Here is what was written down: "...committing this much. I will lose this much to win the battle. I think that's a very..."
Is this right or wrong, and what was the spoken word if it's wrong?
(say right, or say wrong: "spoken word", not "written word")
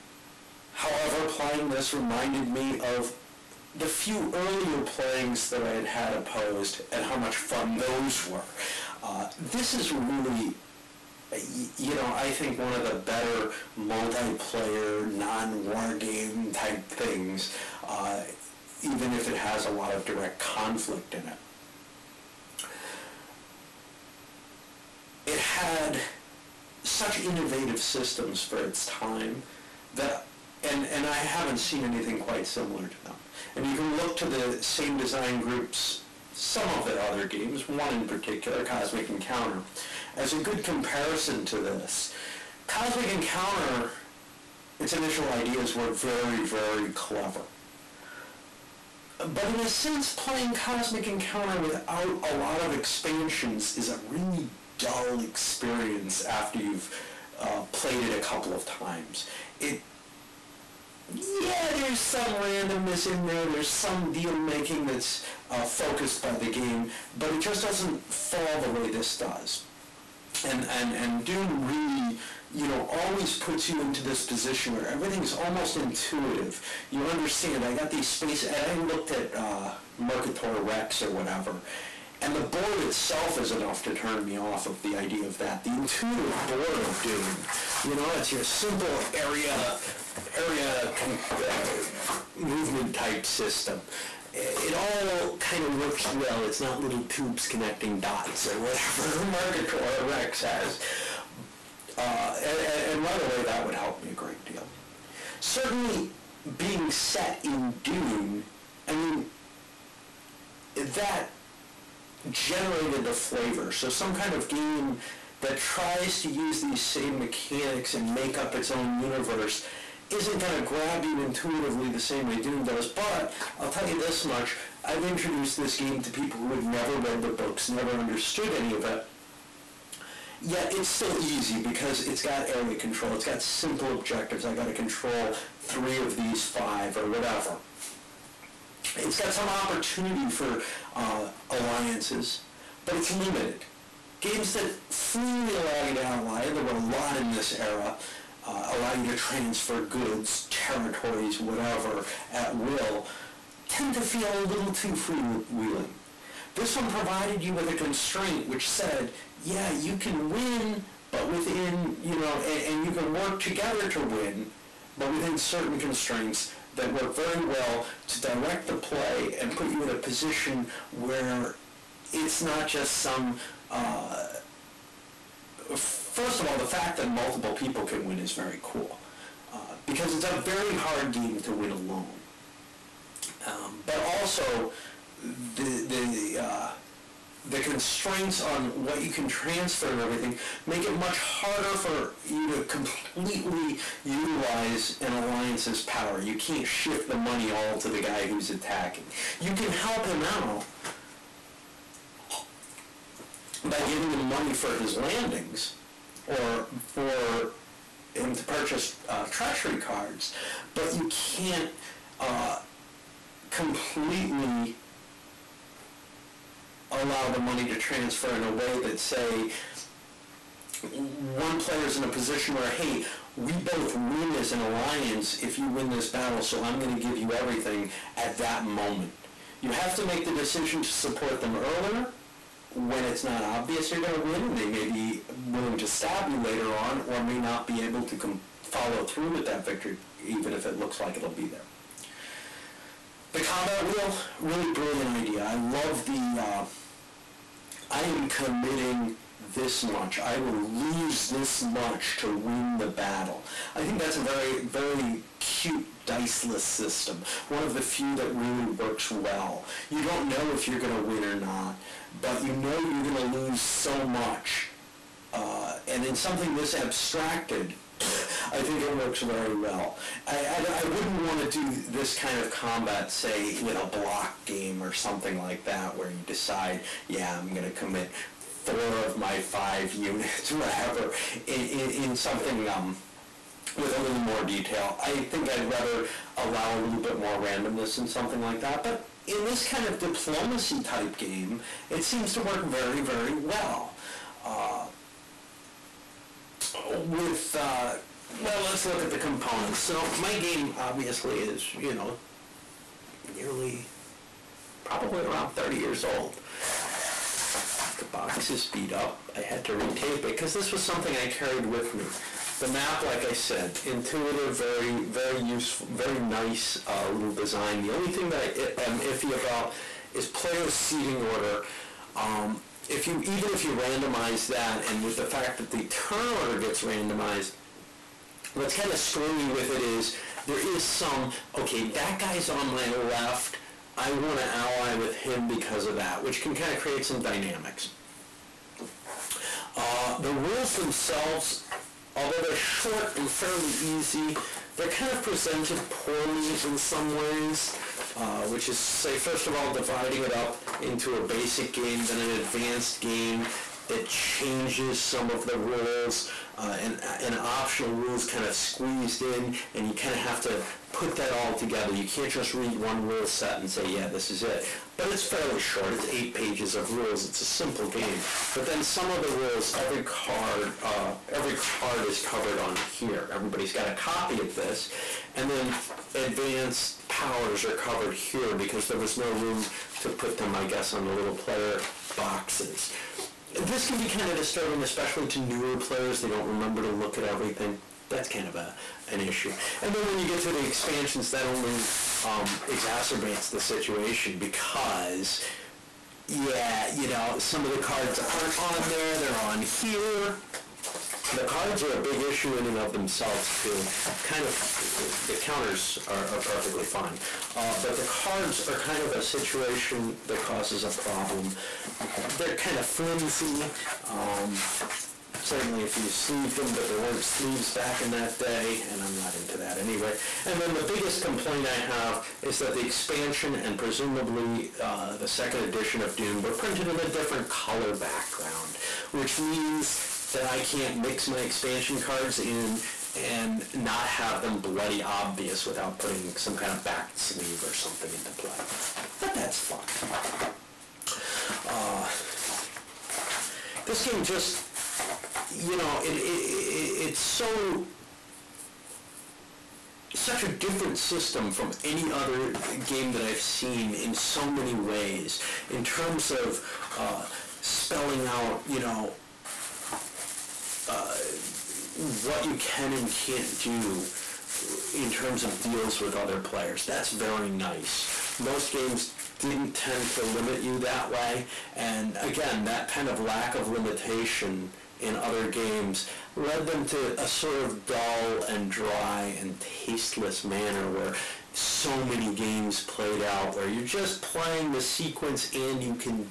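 right.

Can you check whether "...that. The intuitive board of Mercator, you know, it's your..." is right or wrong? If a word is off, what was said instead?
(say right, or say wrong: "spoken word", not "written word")
wrong: "Dune", not "Mercator".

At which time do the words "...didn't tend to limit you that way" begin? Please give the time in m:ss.
7:49.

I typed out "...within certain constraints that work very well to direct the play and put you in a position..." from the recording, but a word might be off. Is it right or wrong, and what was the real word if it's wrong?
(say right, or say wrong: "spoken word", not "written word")
right.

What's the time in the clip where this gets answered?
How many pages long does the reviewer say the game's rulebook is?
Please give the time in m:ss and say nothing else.
6:06.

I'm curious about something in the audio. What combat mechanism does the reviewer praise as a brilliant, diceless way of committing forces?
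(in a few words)
combat wheel.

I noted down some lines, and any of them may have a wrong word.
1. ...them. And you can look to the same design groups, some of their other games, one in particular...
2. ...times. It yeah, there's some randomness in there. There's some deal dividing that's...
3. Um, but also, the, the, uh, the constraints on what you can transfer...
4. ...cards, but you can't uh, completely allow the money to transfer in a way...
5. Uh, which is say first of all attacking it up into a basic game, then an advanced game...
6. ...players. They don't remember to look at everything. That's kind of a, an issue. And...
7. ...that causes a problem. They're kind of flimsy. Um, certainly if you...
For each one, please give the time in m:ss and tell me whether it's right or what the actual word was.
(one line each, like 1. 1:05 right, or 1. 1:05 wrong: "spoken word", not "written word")
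1. 0:33 right
2. 0:58 wrong: "making", not "dividing"
3. 3:03 right
4. 3:29 right
5. 5:48 wrong: "dividing", not "attacking"
6. 6:25 right
7. 6:50 right.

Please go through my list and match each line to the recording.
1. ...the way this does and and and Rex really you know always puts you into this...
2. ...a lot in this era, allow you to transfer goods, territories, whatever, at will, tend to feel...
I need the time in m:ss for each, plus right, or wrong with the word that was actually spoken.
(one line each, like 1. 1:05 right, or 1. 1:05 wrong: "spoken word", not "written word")
1. 1:08 wrong: "Dune", not "Rex"
2. 2:26 right.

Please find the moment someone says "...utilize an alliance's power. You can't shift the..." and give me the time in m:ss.
3:14.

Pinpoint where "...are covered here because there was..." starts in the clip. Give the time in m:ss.
6:17.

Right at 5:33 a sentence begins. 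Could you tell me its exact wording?
I want to ally with him because of that, which can kind of create some dynamics.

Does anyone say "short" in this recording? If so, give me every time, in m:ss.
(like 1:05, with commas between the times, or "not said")
5:42, 6:05.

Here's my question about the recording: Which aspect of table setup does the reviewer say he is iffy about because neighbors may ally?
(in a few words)
player seating order.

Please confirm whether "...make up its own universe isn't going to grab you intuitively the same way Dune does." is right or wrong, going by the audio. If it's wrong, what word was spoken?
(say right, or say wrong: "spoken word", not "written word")
right.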